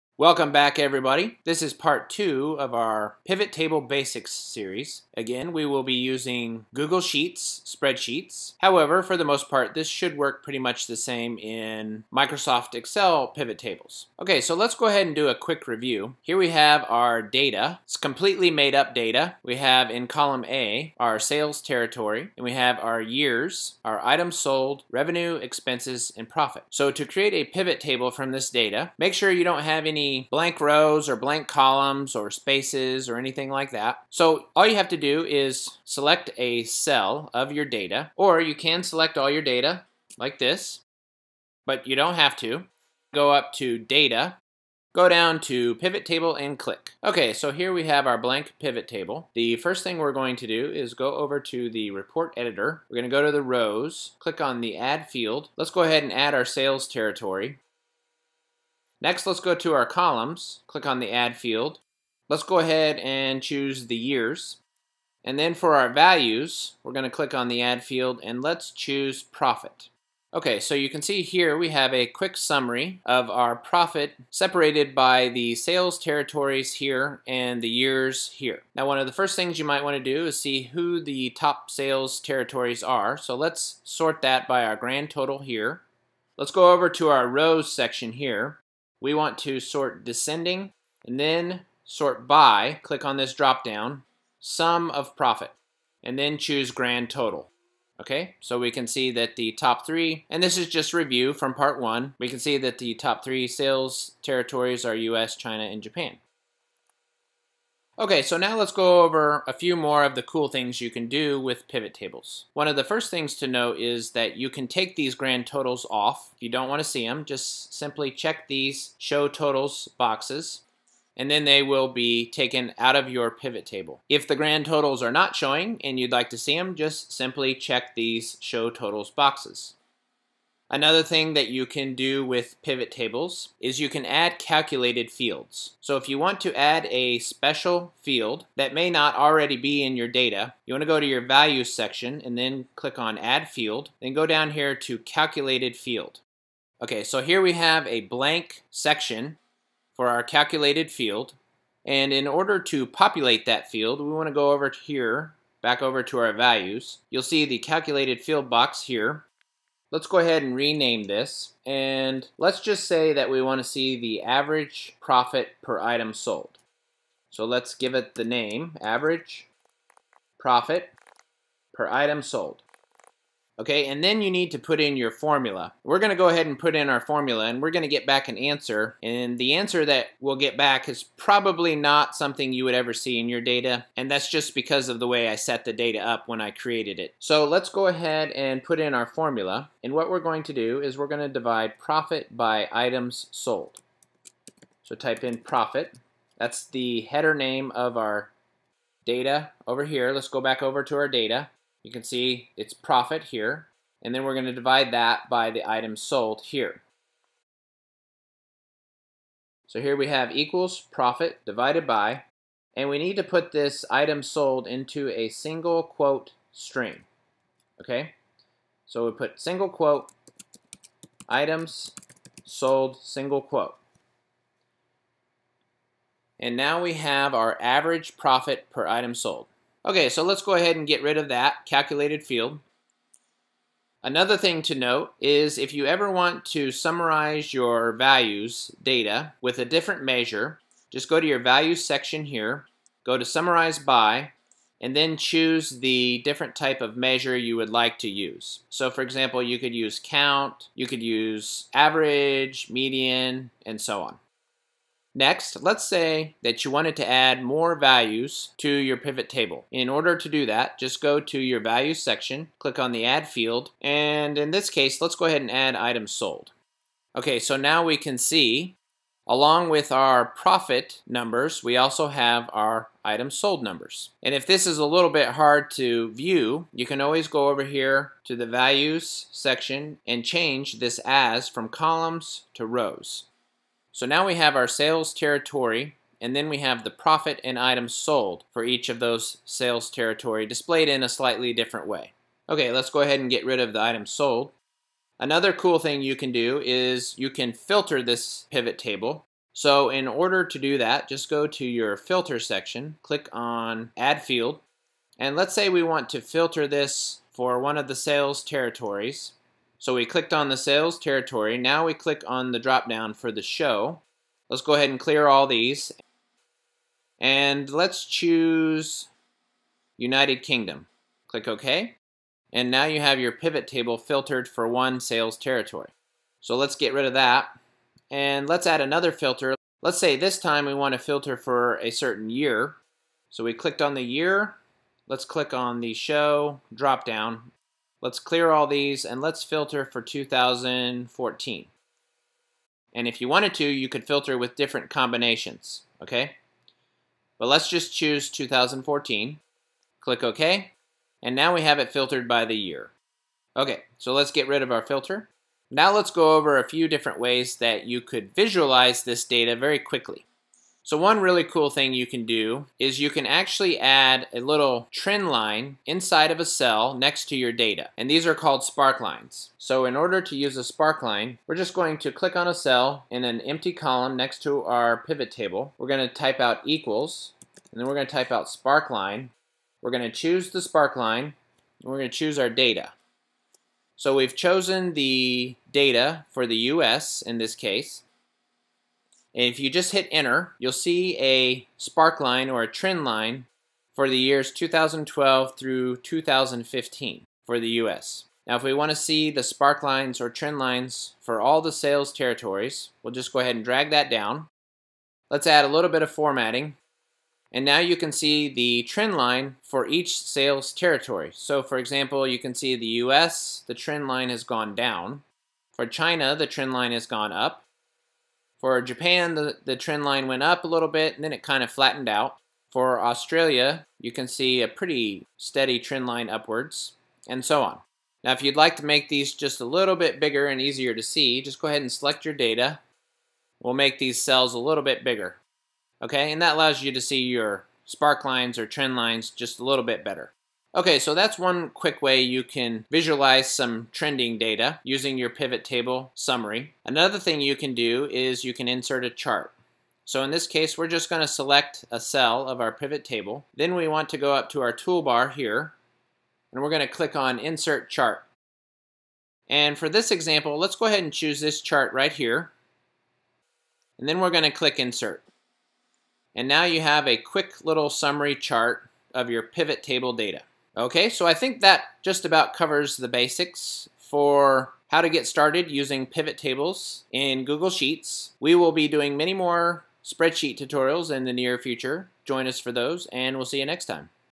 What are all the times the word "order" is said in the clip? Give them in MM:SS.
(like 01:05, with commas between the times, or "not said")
02:32, 04:19, 05:00, 06:09.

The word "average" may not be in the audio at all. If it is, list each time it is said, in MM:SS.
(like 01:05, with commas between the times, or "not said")
02:44, 02:48, 03:47, 04:11.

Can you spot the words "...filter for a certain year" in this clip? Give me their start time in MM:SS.
05:30.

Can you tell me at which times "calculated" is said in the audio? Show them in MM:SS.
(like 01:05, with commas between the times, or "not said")
02:14, 02:24, 02:30, 02:37, 03:51.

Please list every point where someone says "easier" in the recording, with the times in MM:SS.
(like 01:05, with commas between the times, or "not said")
07:10.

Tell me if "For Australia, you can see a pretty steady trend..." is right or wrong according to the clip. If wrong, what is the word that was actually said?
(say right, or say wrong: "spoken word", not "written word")
right.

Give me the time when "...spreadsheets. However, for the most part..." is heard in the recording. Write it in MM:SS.
00:07.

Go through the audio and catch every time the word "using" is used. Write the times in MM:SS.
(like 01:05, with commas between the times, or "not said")
00:05, 07:24, 07:55.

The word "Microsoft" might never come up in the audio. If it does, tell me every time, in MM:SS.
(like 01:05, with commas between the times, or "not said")
00:12.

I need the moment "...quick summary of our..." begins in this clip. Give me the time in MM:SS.
01:12.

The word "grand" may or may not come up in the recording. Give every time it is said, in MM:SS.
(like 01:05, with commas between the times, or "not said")
01:24, 01:36, 01:55, 02:04.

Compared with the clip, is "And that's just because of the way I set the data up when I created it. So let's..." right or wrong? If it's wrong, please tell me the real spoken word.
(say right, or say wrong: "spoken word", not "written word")
right.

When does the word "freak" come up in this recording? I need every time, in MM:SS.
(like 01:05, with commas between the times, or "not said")
not said.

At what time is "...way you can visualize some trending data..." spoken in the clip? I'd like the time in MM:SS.
07:22.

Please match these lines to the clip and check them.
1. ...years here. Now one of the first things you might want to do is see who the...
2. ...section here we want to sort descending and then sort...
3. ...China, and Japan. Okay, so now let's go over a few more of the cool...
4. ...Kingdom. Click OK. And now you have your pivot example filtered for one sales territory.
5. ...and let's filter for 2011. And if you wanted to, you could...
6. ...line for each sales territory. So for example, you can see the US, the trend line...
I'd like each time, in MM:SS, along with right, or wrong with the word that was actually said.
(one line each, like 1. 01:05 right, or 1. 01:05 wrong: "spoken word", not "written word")
1. 01:17 right
2. 01:27 right
3. 01:45 right
4. 05:20 wrong: "table", not "example"
5. 05:39 wrong: "2014", not "2011"
6. 06:49 right.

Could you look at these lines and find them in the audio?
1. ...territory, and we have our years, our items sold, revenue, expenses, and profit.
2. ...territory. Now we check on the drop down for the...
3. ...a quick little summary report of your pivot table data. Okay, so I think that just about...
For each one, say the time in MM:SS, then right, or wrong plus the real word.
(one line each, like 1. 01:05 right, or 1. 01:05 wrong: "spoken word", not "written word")
1. 00:21 right
2. 05:10 wrong: "click", not "check"
3. 07:47 wrong: "chart", not "report".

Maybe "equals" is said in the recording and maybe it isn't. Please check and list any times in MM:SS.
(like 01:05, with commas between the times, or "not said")
03:30, 06:16.